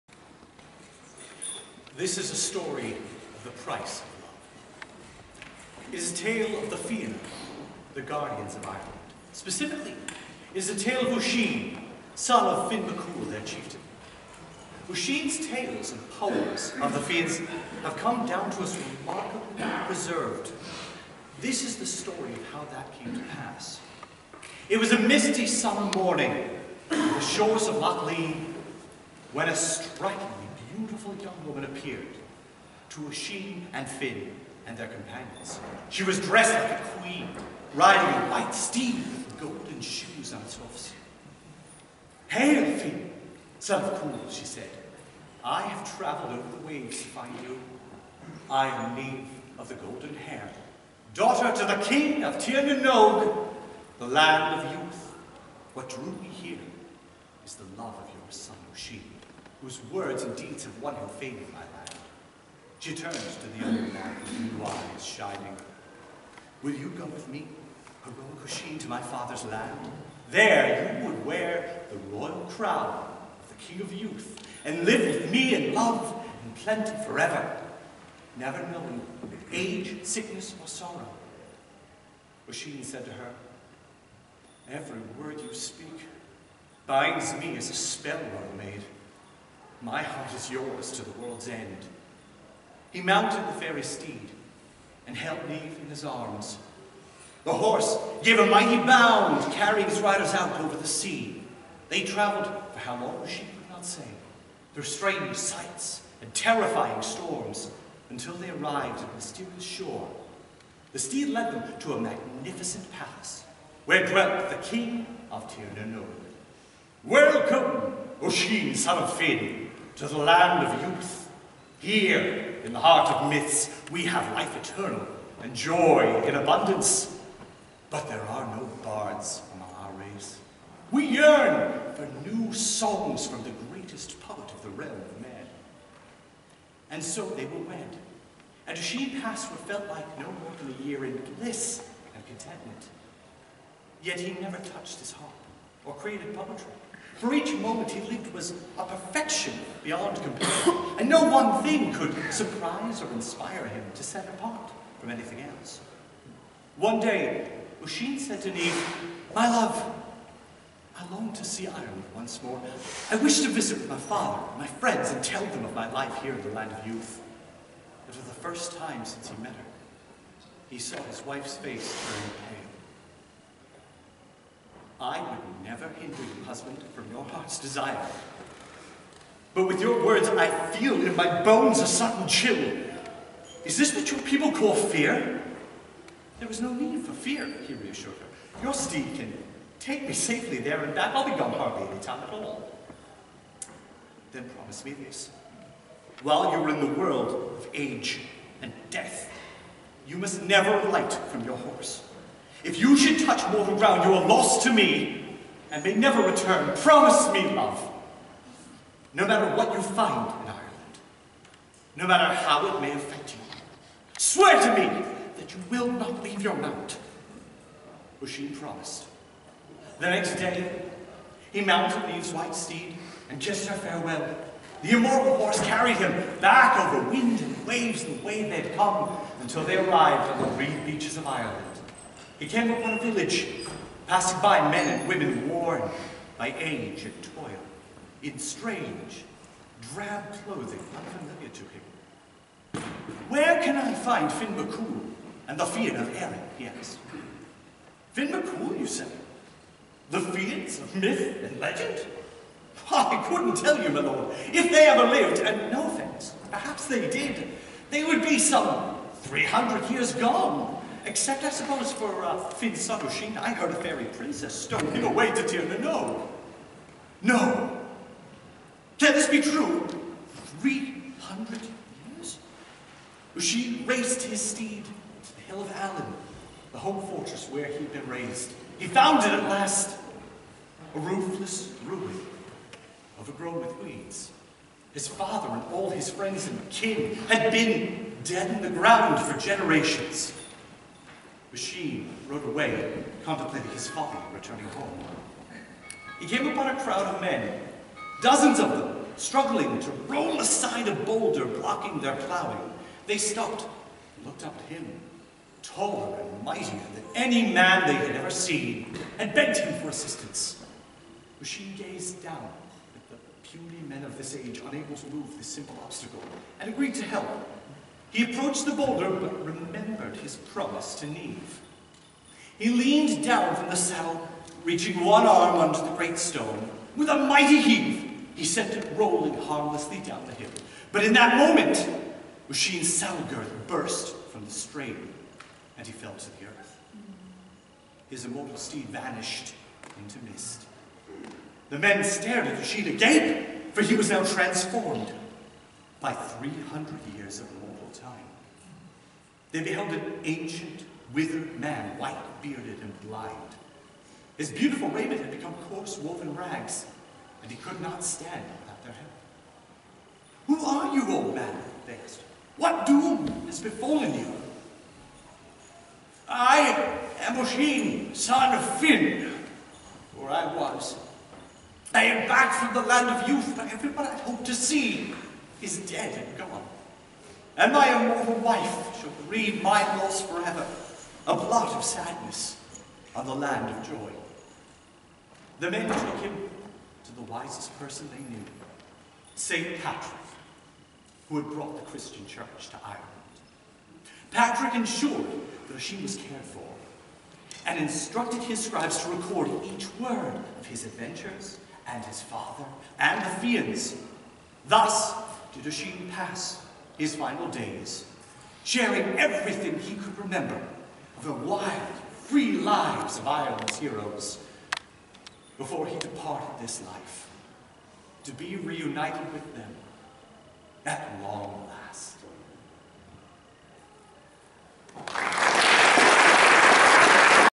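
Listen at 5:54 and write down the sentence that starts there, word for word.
His beautiful raiment had become coarse woven rags, and he could not stand without their help.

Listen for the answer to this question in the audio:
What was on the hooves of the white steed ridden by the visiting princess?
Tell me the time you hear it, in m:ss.
0:39.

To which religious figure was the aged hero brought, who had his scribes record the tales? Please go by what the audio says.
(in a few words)
St. Patrick.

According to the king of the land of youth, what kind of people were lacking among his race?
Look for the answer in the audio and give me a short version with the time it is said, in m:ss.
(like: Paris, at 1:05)
bards, at 2:08.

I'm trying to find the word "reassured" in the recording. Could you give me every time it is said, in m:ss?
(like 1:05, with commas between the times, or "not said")
3:07.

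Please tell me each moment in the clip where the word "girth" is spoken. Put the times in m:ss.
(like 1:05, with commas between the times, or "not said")
5:33.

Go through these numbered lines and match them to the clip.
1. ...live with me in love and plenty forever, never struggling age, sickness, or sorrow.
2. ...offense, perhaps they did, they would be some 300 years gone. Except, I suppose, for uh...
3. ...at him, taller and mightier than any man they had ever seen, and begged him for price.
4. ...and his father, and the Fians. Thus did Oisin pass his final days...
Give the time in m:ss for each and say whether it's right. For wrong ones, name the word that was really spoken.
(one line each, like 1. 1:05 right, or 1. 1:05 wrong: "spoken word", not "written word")
1. 1:14 wrong: "knowing", not "struggling"
2. 4:15 right
3. 5:04 wrong: "assistance", not "price"
4. 6:41 right.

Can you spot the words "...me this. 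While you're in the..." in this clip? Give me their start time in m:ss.
3:14.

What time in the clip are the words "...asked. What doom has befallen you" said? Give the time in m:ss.
6:02.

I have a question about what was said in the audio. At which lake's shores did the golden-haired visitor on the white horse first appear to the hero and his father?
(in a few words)
Loch Léin.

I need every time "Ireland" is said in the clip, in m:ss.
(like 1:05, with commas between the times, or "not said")
0:08, 2:41, 3:30, 3:51, 6:32, 6:53.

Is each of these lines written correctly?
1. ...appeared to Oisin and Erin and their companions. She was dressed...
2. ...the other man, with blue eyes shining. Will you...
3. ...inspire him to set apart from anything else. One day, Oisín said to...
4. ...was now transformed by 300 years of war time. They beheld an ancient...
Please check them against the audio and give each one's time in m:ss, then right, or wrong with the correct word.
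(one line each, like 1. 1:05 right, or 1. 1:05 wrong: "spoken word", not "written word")
1. 0:31 wrong: "Finn", not "Erin"
2. 1:03 right
3. 2:33 right
4. 5:43 right.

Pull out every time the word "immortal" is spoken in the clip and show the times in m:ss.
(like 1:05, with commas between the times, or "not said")
3:44, 5:38, 6:18.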